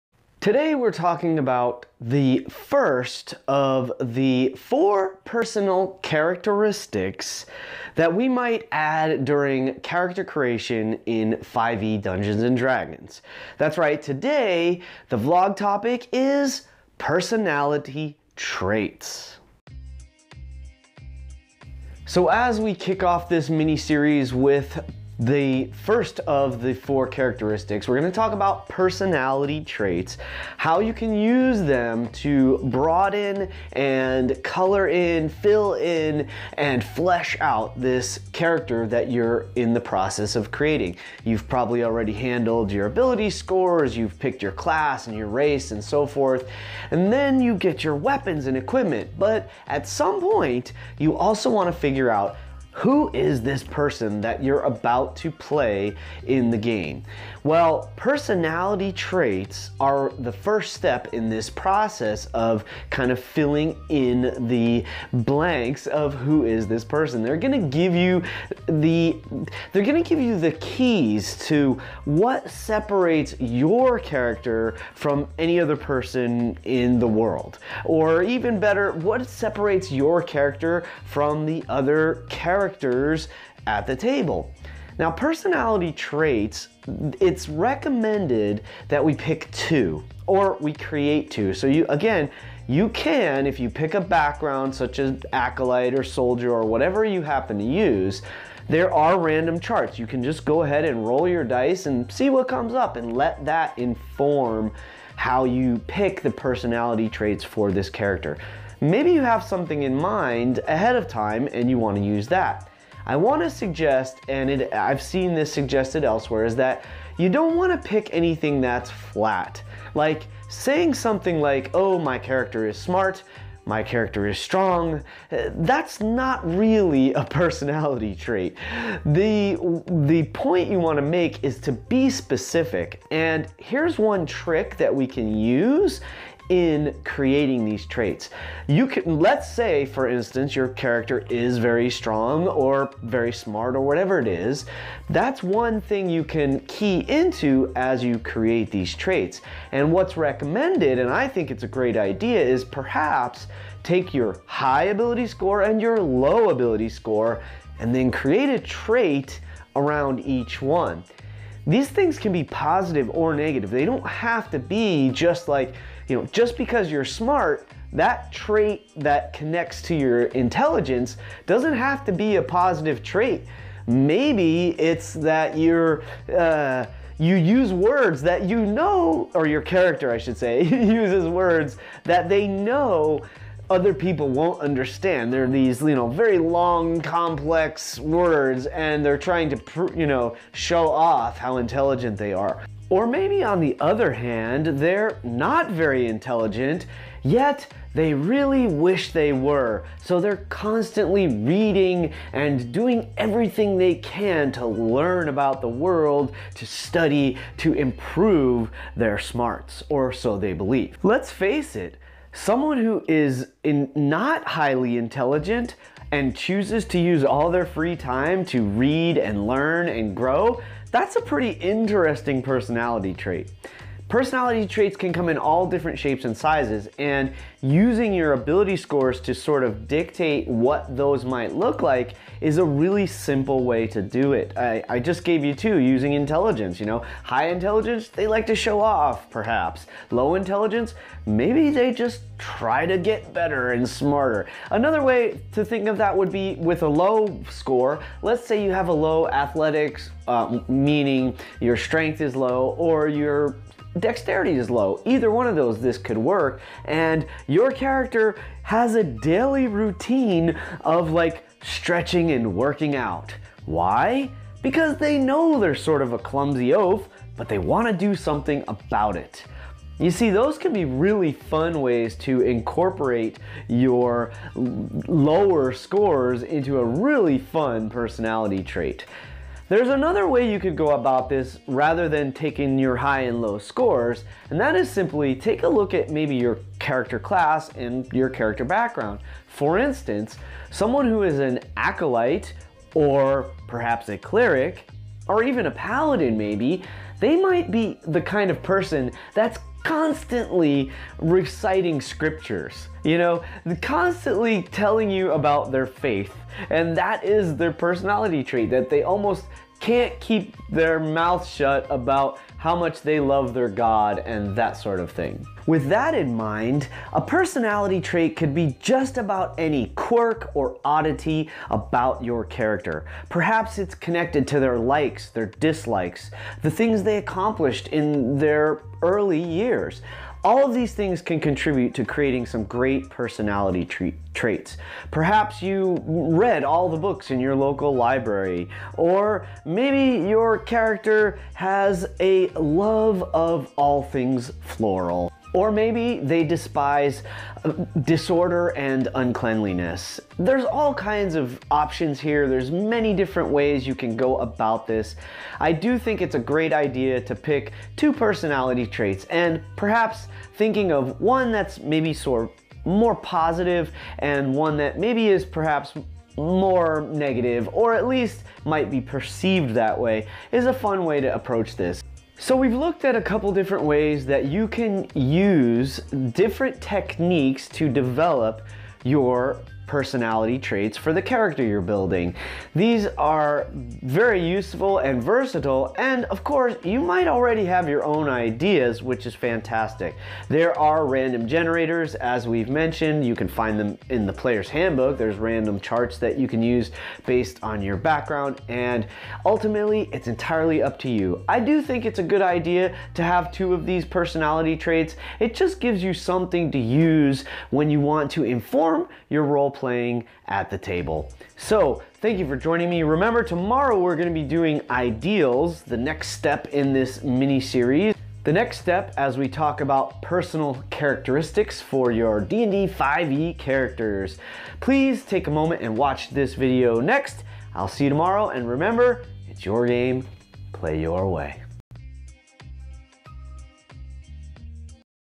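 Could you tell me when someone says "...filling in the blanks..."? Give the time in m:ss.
1:03.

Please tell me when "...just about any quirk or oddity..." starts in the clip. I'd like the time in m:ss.
5:18.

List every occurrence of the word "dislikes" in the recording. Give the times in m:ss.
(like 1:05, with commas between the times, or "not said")
5:25.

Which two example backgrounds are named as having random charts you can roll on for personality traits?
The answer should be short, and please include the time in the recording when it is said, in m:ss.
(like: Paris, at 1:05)
acolyte or soldier, at 1:35.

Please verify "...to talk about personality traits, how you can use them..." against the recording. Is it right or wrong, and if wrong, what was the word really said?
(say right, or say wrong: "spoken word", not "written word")
right.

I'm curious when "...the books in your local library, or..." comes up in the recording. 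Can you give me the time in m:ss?
5:36.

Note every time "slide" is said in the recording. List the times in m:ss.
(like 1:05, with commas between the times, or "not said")
not said.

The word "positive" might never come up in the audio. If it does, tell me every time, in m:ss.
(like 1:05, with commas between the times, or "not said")
2:42, 2:52, 6:03.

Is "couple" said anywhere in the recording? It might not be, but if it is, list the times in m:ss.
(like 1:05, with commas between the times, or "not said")
6:13.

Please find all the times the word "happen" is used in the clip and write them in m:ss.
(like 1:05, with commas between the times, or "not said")
1:37.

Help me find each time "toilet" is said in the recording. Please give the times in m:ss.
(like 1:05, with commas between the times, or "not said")
not said.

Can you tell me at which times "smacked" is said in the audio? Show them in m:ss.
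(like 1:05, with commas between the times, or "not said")
not said.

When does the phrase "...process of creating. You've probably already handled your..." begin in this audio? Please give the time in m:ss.
0:39.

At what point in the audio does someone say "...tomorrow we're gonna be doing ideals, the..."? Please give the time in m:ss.
6:53.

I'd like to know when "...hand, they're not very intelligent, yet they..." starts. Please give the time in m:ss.
3:14.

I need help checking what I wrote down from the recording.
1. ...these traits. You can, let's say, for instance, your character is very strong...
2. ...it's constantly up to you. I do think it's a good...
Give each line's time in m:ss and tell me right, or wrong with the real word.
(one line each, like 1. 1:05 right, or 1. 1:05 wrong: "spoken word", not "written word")
1. 2:17 right
2. 6:40 wrong: "entirely", not "constantly".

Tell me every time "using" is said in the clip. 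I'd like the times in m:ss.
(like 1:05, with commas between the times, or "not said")
3:47, 3:55.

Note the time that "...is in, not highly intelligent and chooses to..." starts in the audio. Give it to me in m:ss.
3:33.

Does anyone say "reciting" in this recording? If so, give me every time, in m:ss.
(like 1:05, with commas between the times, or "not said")
5:01.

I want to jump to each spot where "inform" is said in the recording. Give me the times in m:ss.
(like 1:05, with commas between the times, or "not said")
1:43, 6:48.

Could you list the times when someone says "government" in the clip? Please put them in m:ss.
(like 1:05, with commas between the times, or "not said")
not said.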